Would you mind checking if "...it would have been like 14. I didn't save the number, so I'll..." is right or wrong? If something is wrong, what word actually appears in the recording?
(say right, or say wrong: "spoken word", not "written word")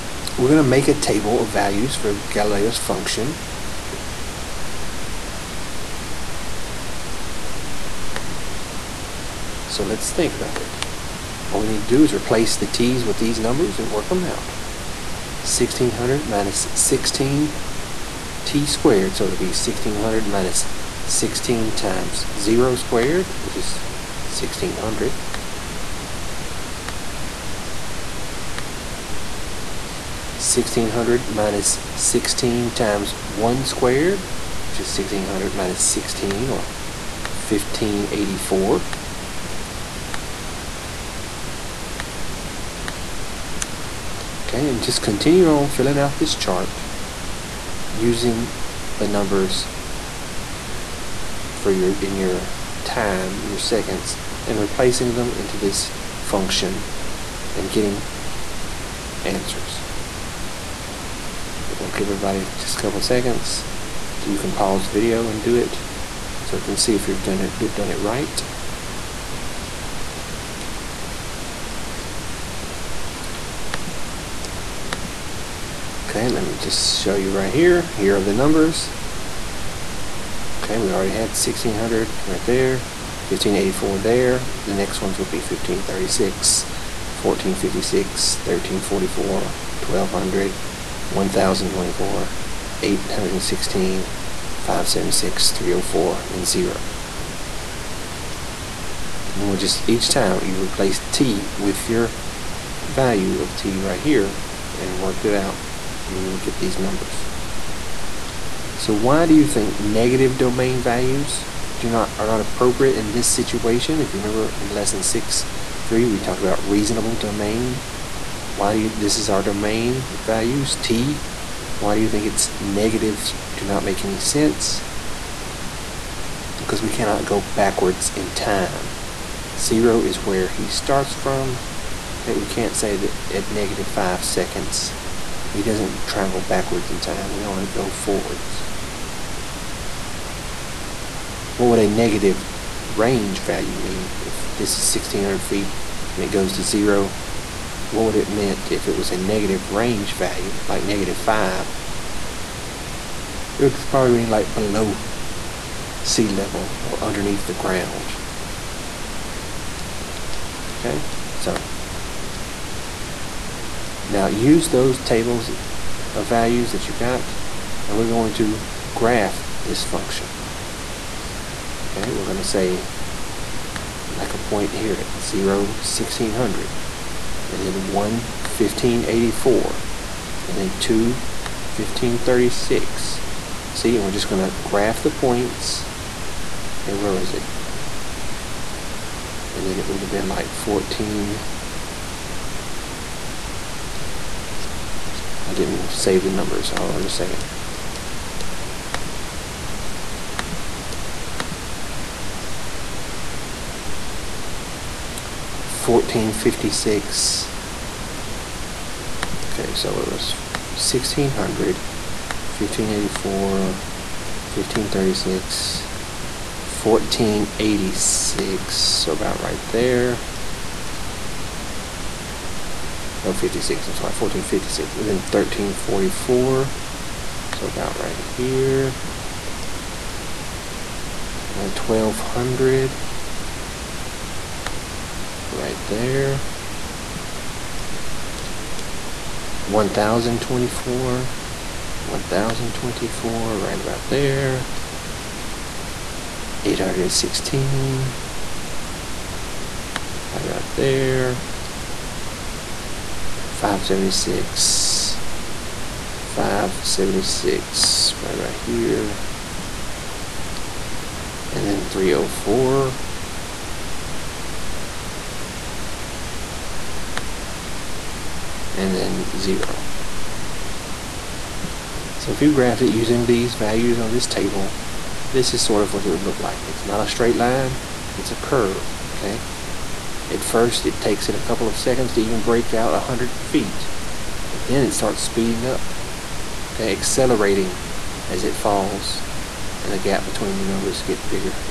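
right.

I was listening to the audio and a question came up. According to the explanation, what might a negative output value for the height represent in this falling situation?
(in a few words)
below sea level.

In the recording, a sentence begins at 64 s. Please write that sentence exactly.
You can pause the video and do it so we can see if you've done it done it right.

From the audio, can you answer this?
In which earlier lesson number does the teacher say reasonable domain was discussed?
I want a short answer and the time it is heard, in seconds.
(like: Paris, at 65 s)
6.3, at 114 s.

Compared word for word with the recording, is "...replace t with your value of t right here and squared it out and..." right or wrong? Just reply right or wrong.
wrong.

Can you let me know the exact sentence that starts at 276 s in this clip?
It's not a straight line, it's a curve, okay?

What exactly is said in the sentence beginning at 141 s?
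What would a negative range value mean?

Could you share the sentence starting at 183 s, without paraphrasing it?
See, and we're just going to graph the points.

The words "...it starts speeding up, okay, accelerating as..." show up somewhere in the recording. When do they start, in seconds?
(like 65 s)
284 s.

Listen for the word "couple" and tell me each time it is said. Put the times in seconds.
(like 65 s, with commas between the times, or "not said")
62 s, 281 s.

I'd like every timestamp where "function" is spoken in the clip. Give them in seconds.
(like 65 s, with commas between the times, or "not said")
2 s, 56 s, 169 s.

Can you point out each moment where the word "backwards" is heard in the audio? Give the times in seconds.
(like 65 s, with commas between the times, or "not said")
127 s, 136 s.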